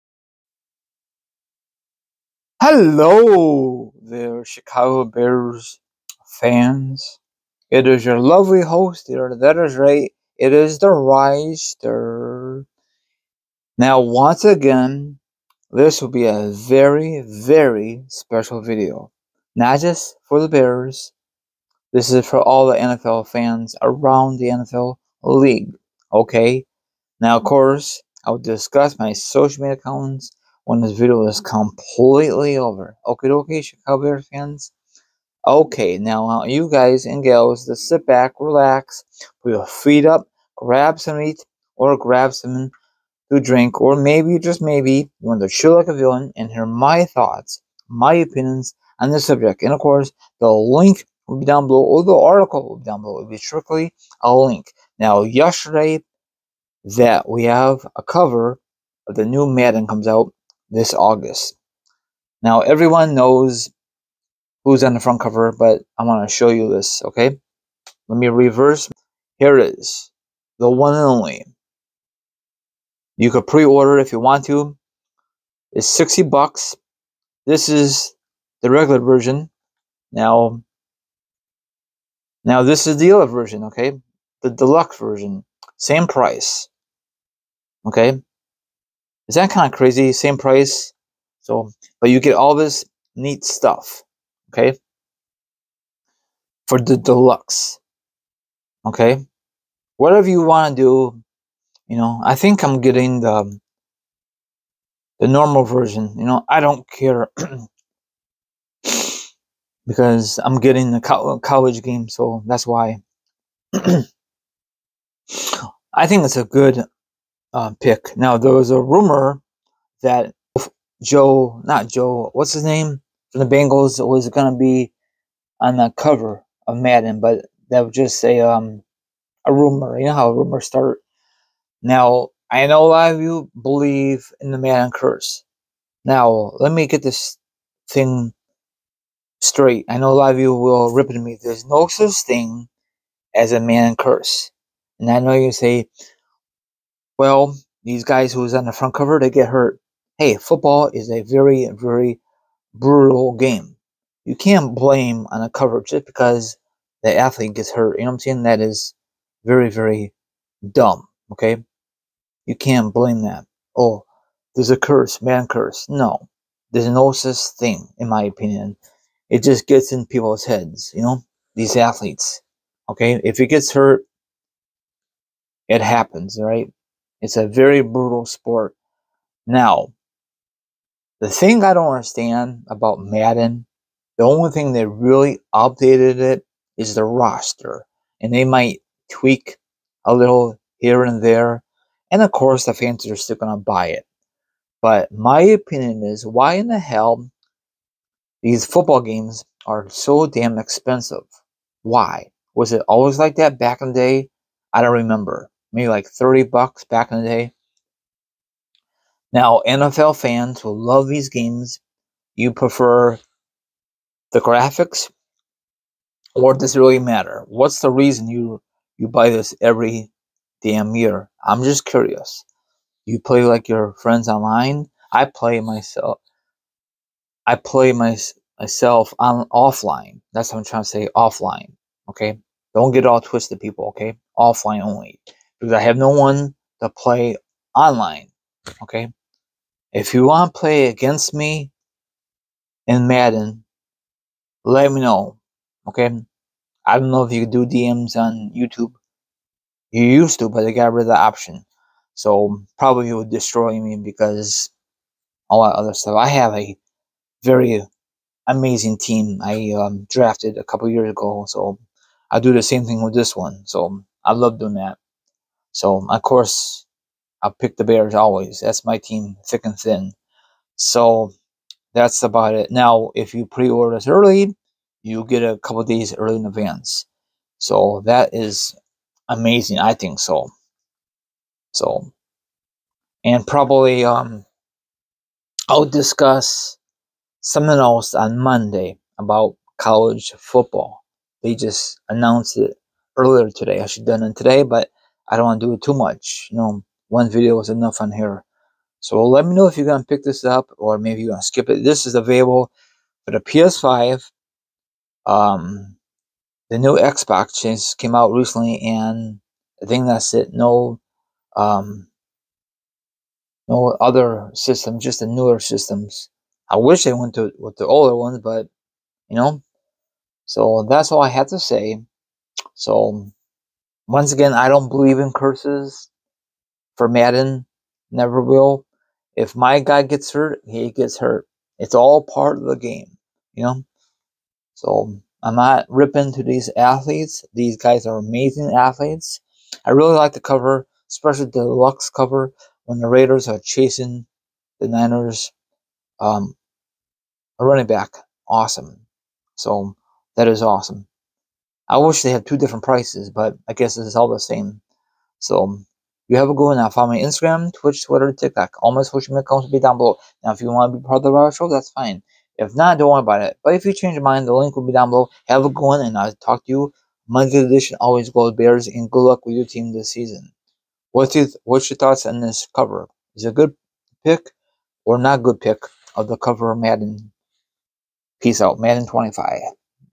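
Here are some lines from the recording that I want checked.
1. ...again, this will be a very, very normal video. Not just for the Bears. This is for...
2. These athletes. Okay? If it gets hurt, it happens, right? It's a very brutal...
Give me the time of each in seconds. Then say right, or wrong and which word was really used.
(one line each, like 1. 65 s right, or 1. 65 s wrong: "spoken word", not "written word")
1. 14 s wrong: "special", not "normal"
2. 171 s right.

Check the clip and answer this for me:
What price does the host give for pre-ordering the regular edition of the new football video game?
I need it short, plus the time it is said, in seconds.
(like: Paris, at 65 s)
60 bucks, at 75 s.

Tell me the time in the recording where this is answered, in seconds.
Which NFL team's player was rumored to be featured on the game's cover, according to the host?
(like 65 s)
123 s.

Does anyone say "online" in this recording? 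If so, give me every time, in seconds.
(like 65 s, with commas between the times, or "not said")
224 s, 237 s.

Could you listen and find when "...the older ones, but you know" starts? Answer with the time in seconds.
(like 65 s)
317 s.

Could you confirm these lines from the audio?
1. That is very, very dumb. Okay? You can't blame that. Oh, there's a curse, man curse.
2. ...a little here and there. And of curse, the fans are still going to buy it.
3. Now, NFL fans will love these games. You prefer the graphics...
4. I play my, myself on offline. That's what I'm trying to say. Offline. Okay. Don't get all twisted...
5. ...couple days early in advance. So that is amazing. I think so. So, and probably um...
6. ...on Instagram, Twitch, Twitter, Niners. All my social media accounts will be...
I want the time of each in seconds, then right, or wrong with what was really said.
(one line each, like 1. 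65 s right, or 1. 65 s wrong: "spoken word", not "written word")
1. 158 s right
2. 190 s wrong: "course", not "curse"
3. 209 s right
4. 227 s right
5. 275 s right
6. 357 s wrong: "TikTok", not "Niners".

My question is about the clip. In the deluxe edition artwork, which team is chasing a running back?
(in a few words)
Raiders.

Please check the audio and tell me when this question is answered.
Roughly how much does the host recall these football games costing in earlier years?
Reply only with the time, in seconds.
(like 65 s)
206 s.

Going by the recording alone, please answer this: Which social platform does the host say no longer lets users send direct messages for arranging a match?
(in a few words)
YouTube.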